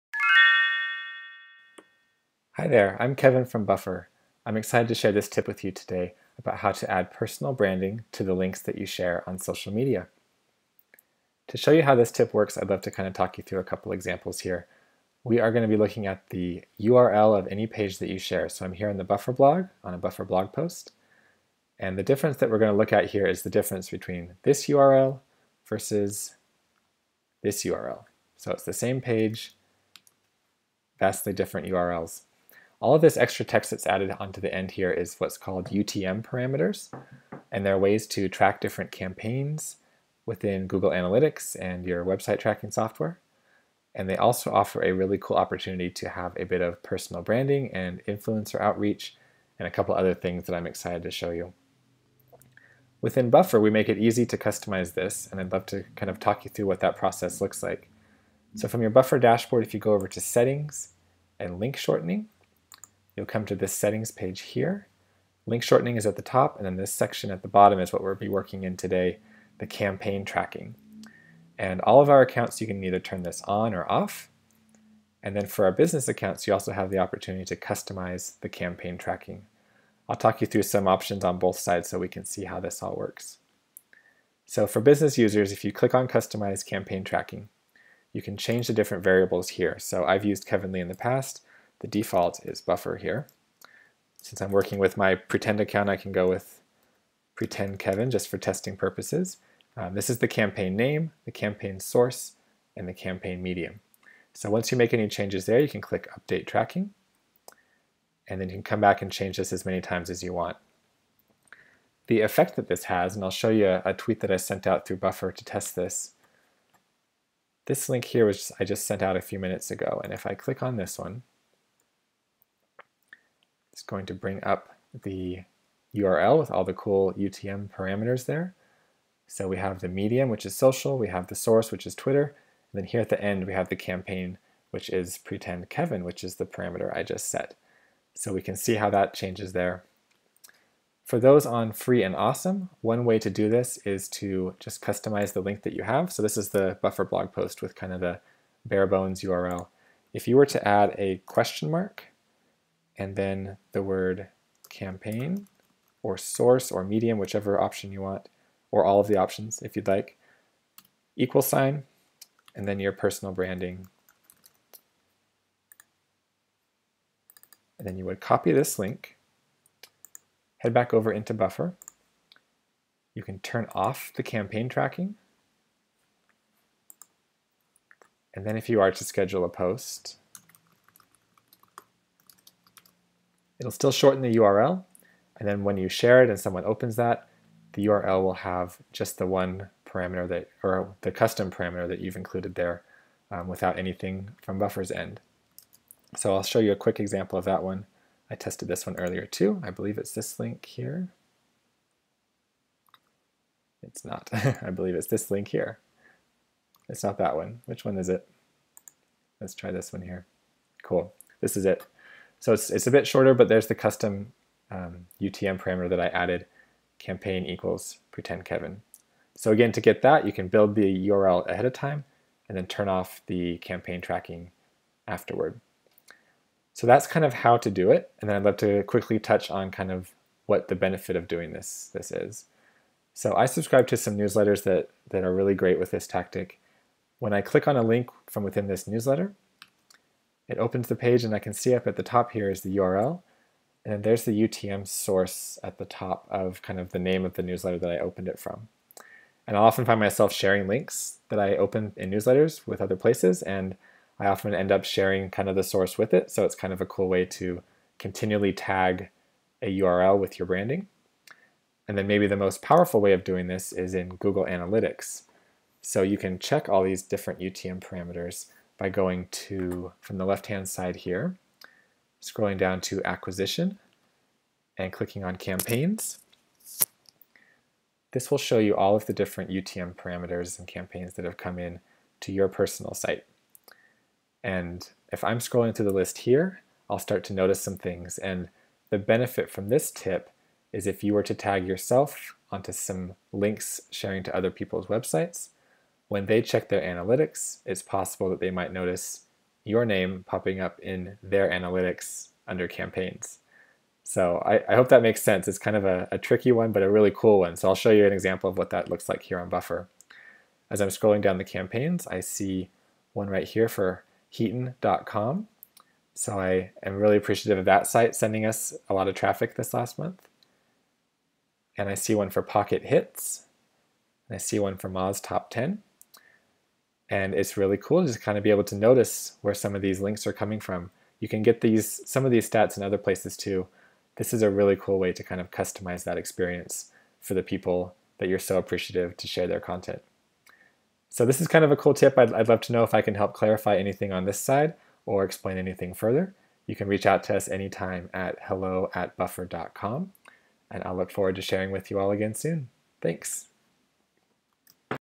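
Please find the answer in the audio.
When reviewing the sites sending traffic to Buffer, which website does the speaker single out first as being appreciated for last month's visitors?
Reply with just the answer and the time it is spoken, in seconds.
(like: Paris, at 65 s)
Heaton.com, at 314 s.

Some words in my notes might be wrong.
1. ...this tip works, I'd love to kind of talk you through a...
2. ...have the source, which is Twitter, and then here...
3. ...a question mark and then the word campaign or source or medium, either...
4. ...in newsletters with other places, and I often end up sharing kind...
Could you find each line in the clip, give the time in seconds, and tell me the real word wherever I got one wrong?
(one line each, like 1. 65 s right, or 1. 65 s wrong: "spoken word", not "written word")
1. 11 s right
2. 131 s right
3. 150 s wrong: "whichever", not "either"
4. 251 s right.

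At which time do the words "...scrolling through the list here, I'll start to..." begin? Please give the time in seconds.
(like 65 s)
285 s.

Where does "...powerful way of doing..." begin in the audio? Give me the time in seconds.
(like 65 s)
262 s.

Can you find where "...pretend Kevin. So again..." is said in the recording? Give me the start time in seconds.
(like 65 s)
218 s.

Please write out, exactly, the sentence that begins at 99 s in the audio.
Um, this is the campaign name, the campaign source, and the campaign medium.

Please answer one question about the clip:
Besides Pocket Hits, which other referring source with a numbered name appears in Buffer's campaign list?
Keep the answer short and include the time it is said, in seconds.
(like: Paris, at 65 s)
Moz Top 10, at 324 s.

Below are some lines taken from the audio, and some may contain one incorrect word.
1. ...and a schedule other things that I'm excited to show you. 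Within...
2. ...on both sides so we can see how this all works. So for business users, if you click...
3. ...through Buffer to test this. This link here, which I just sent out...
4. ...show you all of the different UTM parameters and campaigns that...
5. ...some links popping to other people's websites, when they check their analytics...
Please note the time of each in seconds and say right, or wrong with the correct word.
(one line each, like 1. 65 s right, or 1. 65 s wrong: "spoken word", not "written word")
1. 49 s wrong: "couple", not "schedule"
2. 81 s right
3. 114 s right
4. 278 s right
5. 292 s wrong: "sharing", not "popping".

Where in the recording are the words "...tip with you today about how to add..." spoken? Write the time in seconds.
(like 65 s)
5 s.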